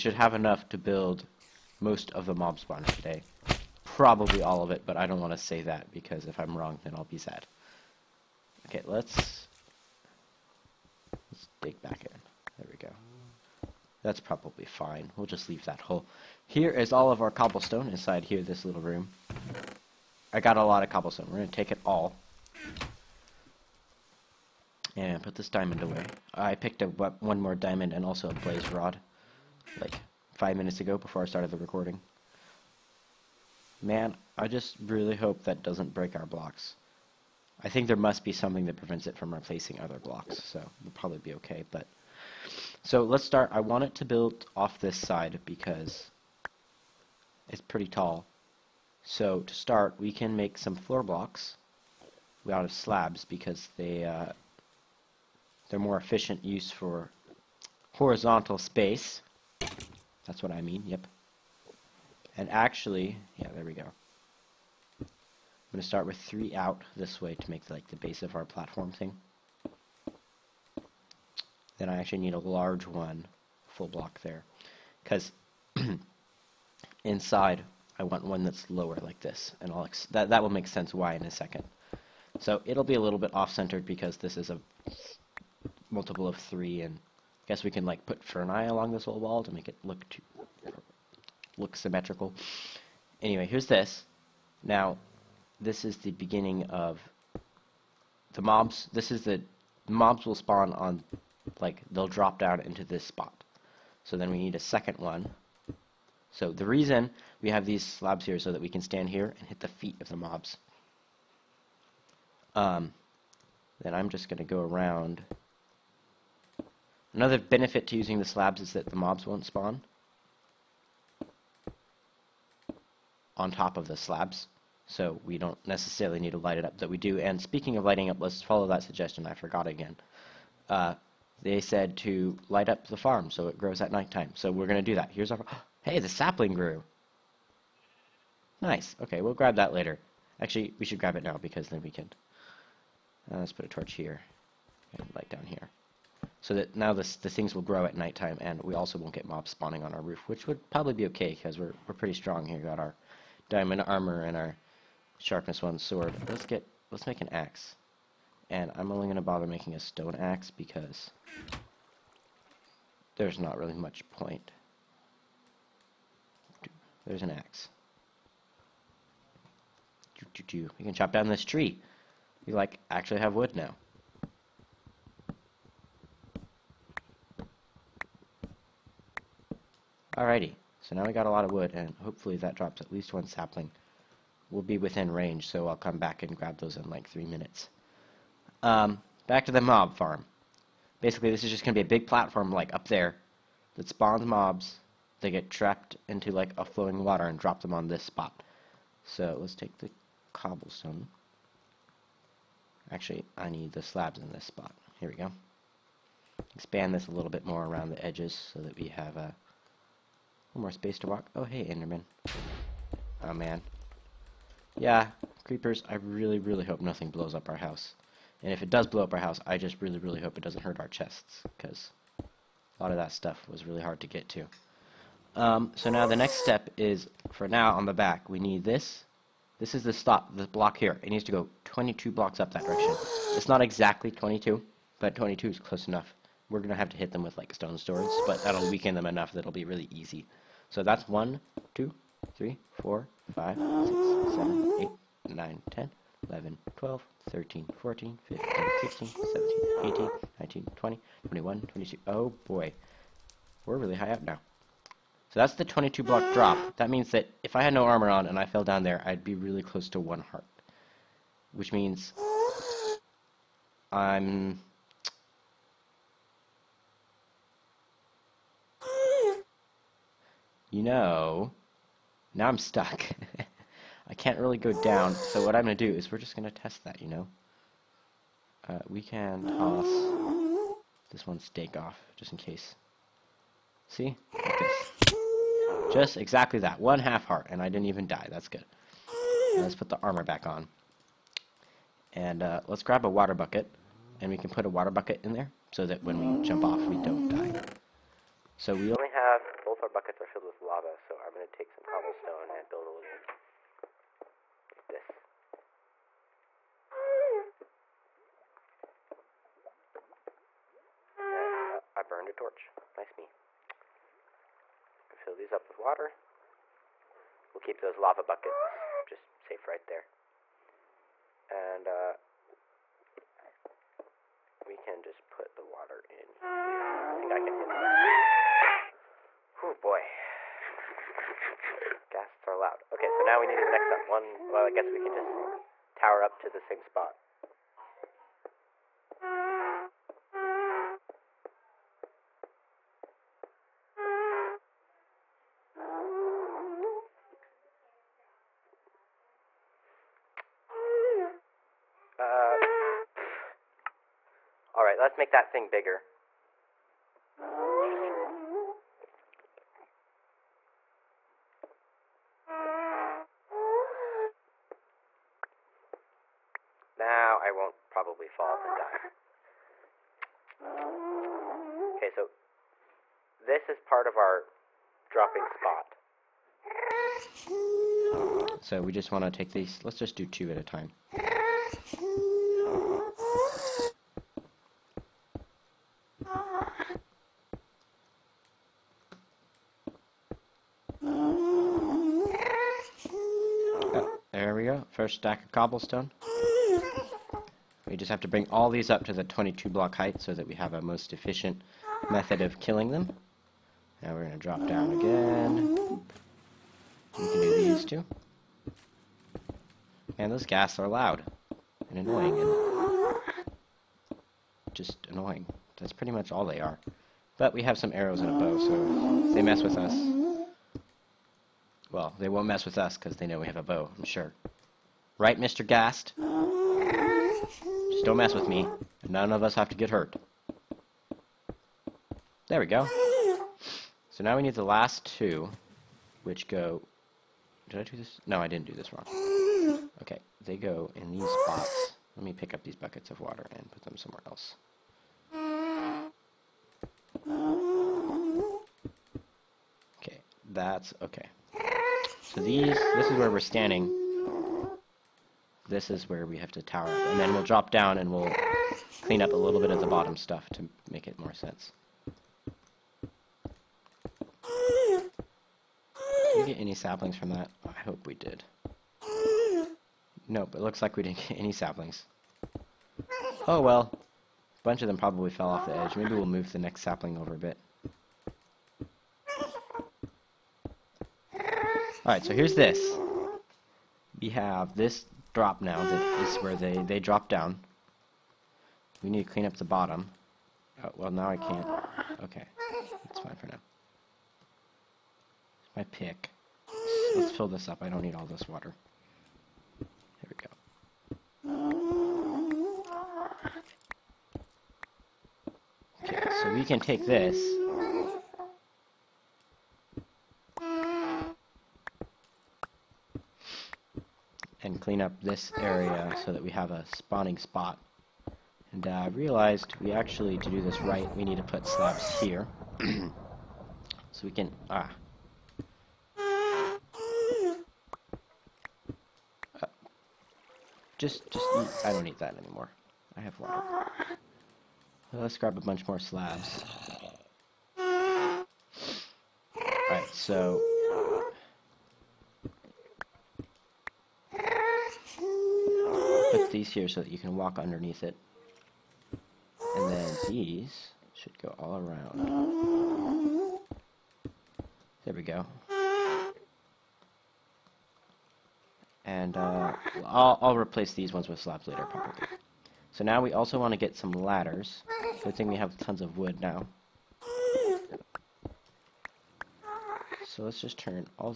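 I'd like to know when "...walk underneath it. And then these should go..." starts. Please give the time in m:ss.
9:07.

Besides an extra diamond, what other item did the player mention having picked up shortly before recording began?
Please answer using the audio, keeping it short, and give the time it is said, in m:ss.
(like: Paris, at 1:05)
blaze rod, at 0:28.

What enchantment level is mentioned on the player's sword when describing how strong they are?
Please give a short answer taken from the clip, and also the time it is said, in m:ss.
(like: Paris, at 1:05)
sharpness 1, at 2:35.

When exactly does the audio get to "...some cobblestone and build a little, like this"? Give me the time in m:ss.
5:01.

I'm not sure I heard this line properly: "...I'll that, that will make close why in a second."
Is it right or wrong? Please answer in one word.
wrong.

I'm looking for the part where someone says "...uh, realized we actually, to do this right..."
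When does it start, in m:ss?
8:39.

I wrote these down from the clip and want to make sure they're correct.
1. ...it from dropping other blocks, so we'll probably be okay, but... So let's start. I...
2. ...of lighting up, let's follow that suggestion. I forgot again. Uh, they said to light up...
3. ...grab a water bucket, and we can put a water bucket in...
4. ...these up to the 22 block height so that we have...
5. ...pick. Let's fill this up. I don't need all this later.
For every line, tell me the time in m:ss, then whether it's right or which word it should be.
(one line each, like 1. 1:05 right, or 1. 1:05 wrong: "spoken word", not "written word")
1. 0:39 wrong: "replacing", not "dropping"
2. 2:07 right
3. 4:52 right
4. 6:38 right
5. 8:15 wrong: "water", not "later".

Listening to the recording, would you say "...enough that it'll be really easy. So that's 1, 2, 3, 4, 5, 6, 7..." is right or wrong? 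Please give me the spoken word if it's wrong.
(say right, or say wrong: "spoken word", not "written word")
right.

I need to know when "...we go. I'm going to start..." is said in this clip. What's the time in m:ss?
1:03.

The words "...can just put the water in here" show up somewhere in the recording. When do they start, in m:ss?
5:24.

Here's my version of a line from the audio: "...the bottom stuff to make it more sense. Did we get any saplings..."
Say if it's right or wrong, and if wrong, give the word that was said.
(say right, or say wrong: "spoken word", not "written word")
right.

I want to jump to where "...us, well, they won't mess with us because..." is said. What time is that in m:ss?
6:59.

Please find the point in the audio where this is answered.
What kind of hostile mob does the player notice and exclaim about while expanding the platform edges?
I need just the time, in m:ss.
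3:31.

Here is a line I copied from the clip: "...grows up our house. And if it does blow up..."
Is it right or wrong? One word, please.
wrong.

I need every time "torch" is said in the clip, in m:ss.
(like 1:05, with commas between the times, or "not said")
2:23, 5:12.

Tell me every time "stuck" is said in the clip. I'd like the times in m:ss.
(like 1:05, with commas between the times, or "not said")
4:32.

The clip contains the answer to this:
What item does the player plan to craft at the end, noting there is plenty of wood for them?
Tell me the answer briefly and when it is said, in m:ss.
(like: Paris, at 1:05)
ladders, at 9:24.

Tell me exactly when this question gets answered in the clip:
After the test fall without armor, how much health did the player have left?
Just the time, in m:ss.
4:46.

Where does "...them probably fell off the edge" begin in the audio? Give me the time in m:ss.
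7:54.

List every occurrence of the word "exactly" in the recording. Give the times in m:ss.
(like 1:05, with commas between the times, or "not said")
3:53, 4:46.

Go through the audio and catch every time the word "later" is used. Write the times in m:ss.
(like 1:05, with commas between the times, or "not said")
2:19, 9:21.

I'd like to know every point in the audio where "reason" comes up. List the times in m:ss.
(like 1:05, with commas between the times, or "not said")
1:46.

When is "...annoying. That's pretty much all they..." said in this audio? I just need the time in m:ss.
6:55.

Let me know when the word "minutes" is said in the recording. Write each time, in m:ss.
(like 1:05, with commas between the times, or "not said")
0:30, 3:07.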